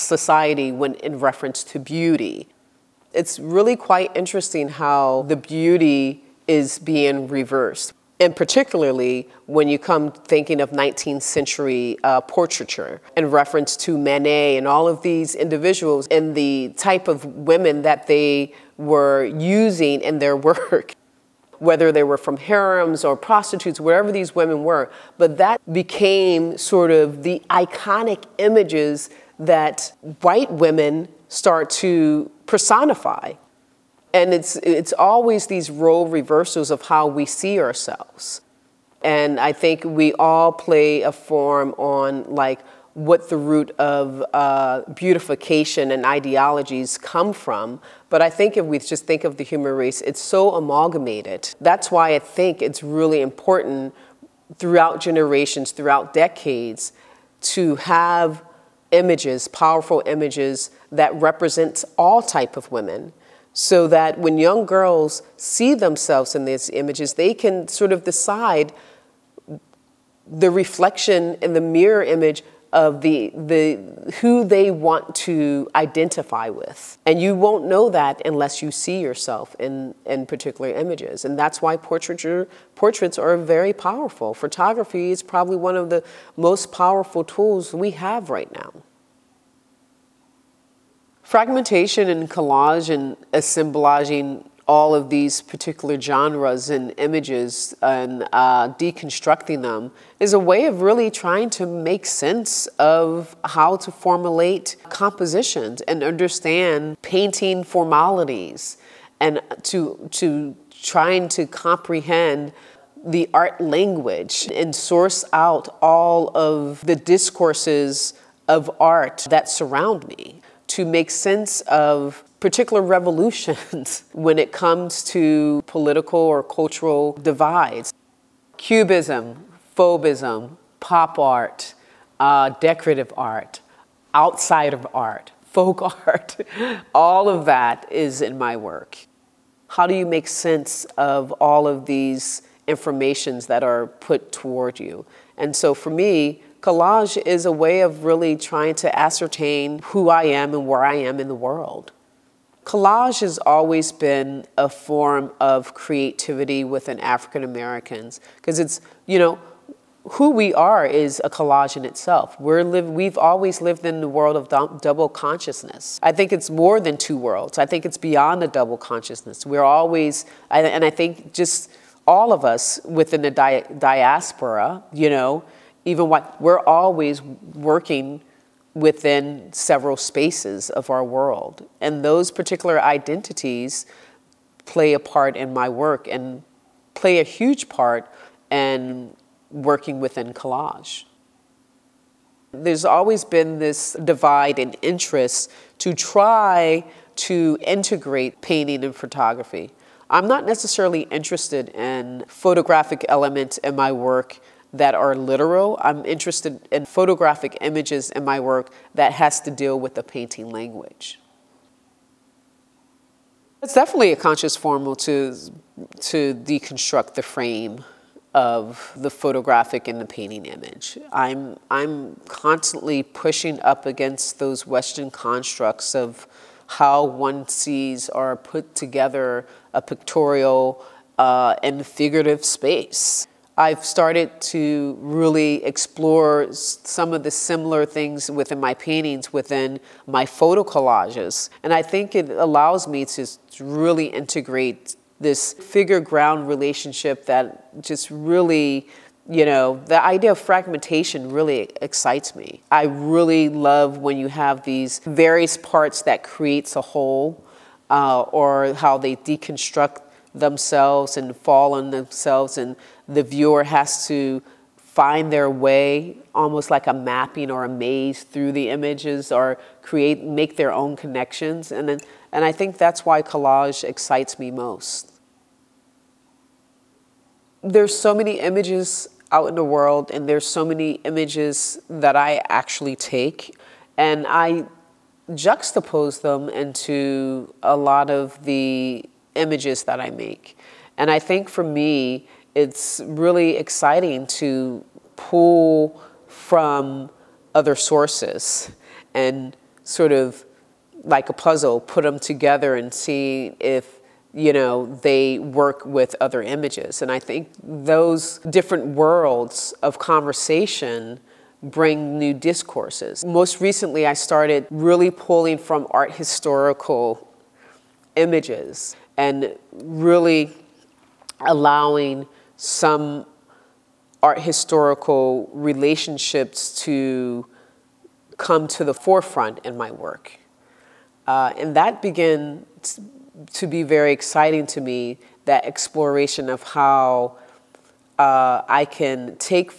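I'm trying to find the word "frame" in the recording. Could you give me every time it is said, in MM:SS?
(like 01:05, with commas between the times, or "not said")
03:37.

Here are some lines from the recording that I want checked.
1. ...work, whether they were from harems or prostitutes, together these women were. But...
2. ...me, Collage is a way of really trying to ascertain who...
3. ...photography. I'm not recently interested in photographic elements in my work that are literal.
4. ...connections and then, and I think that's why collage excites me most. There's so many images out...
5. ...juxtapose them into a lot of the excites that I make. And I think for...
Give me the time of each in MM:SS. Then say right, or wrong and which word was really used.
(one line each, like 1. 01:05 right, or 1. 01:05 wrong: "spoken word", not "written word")
1. 00:20 wrong: "wherever", not "together"
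2. 02:25 right
3. 03:18 wrong: "necessarily", not "recently"
4. 04:30 right
5. 04:45 wrong: "images", not "excites".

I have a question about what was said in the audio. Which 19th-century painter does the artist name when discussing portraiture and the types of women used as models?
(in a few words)
Manet.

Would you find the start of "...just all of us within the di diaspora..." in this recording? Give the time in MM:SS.
02:51.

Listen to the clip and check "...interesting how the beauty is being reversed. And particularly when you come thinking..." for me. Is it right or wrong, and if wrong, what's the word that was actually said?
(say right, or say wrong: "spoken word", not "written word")
right.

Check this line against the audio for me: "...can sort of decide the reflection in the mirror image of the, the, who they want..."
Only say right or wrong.
right.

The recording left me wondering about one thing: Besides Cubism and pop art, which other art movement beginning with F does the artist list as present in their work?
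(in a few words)
Fauvism.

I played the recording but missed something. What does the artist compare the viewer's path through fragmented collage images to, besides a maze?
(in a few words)
a mapping.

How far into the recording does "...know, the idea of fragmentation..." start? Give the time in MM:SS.
04:09.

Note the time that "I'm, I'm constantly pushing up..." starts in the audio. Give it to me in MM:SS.
03:41.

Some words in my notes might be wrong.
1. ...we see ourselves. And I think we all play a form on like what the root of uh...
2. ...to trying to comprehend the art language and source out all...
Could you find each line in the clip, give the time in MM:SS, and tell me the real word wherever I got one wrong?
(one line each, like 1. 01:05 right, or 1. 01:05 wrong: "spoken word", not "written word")
1. 00:37 right
2. 01:50 right.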